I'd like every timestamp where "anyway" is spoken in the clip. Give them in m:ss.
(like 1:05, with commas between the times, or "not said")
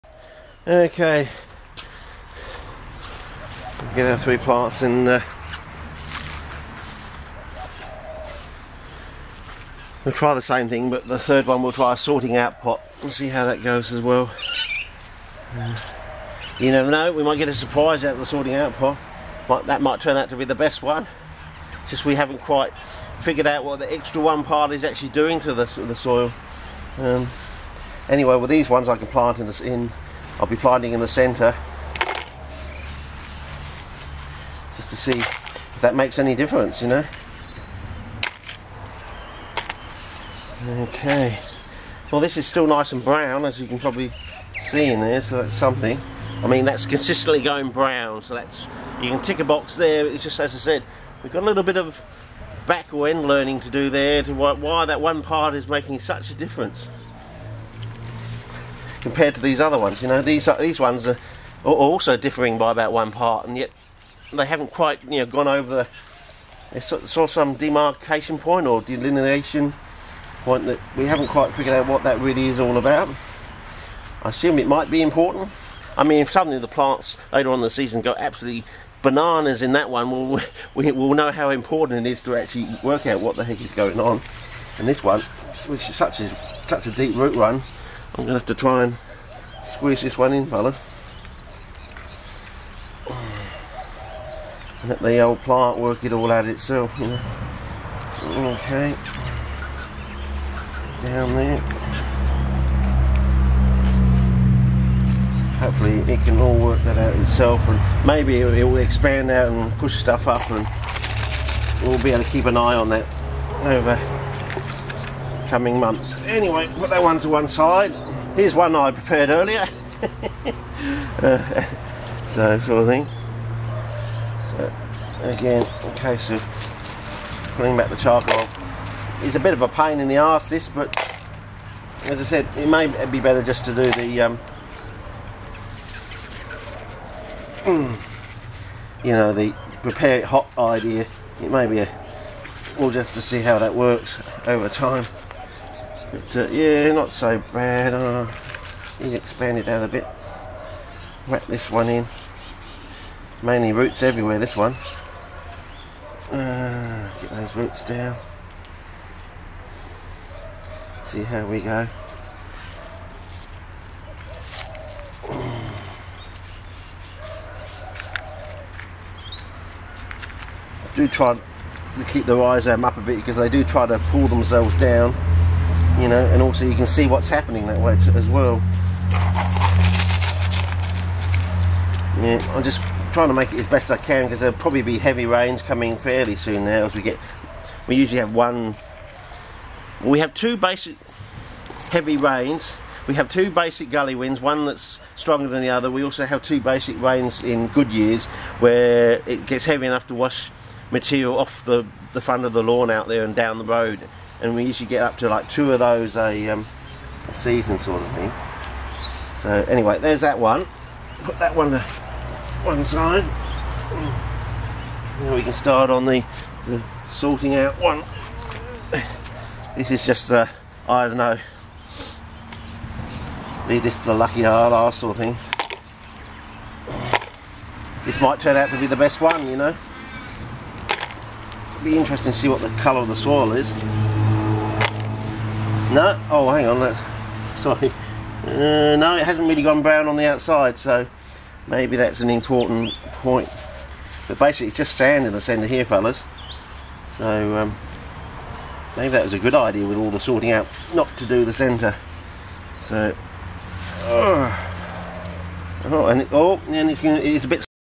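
0:28, 1:56, 3:29.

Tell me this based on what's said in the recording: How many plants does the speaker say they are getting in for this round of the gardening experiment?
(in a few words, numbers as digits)
3.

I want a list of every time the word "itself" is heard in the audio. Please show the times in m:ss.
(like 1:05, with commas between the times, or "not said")
1:36, 1:47.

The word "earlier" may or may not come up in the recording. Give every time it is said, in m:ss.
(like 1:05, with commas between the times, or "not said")
1:59.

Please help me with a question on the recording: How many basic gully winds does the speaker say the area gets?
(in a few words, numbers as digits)
2.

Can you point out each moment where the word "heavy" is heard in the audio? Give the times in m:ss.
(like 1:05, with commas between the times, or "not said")
3:04, 3:11, 3:19.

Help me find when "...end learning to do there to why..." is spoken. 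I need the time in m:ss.
0:53.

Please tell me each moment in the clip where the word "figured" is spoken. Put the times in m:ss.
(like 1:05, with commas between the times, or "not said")
0:23, 1:11.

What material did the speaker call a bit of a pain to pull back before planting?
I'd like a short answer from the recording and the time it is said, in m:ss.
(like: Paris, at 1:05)
charcoal, at 2:07.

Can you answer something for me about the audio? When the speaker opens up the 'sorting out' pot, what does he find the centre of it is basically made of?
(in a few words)
sand.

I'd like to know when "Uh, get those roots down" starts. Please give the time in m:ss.
2:36.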